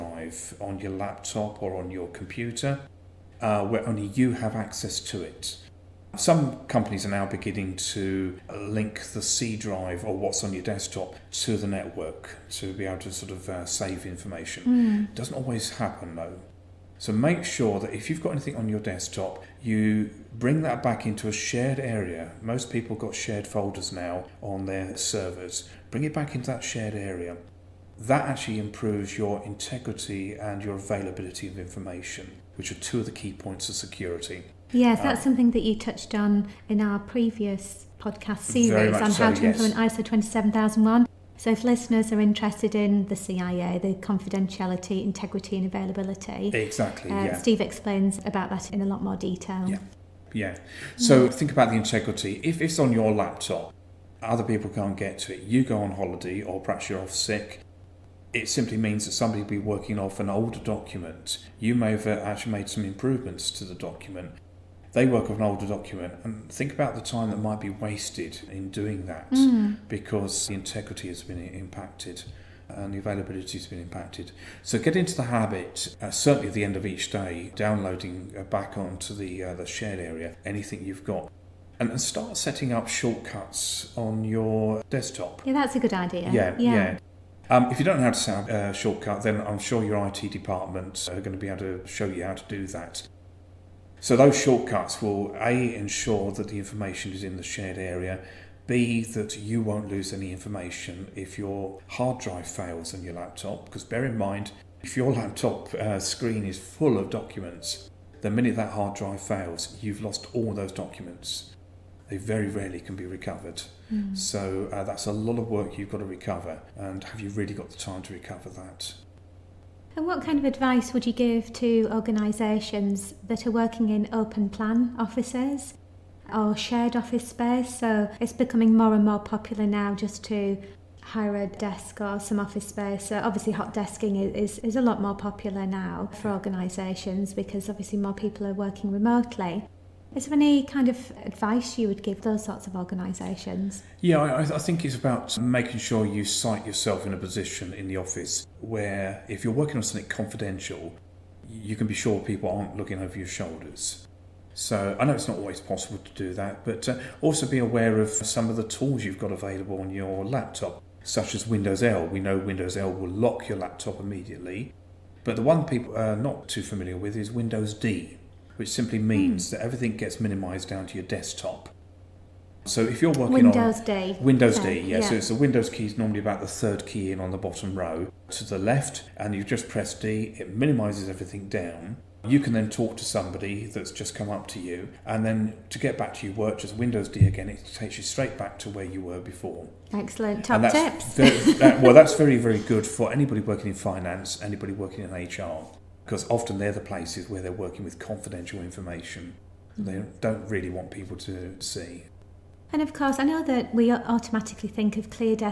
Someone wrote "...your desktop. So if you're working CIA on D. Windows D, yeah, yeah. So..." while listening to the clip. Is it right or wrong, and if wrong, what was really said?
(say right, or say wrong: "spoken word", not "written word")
wrong: "Windows", not "CIA".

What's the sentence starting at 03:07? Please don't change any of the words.
It takes you straight back to where you were before.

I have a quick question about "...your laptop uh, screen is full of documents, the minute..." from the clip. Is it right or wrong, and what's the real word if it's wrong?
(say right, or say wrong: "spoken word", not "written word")
right.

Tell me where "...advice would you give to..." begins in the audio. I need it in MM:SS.
02:00.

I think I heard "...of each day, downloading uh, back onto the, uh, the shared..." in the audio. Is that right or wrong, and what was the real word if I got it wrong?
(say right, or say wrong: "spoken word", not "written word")
right.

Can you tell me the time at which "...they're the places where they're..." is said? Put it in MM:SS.
03:16.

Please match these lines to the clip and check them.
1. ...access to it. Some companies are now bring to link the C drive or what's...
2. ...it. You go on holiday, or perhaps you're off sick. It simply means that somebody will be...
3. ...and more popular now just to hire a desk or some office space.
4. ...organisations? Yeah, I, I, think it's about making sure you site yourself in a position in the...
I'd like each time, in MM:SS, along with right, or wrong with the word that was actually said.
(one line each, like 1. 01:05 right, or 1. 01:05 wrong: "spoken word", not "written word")
1. 00:04 wrong: "beginning", not "bring"
2. 00:55 right
3. 02:08 right
4. 02:22 right.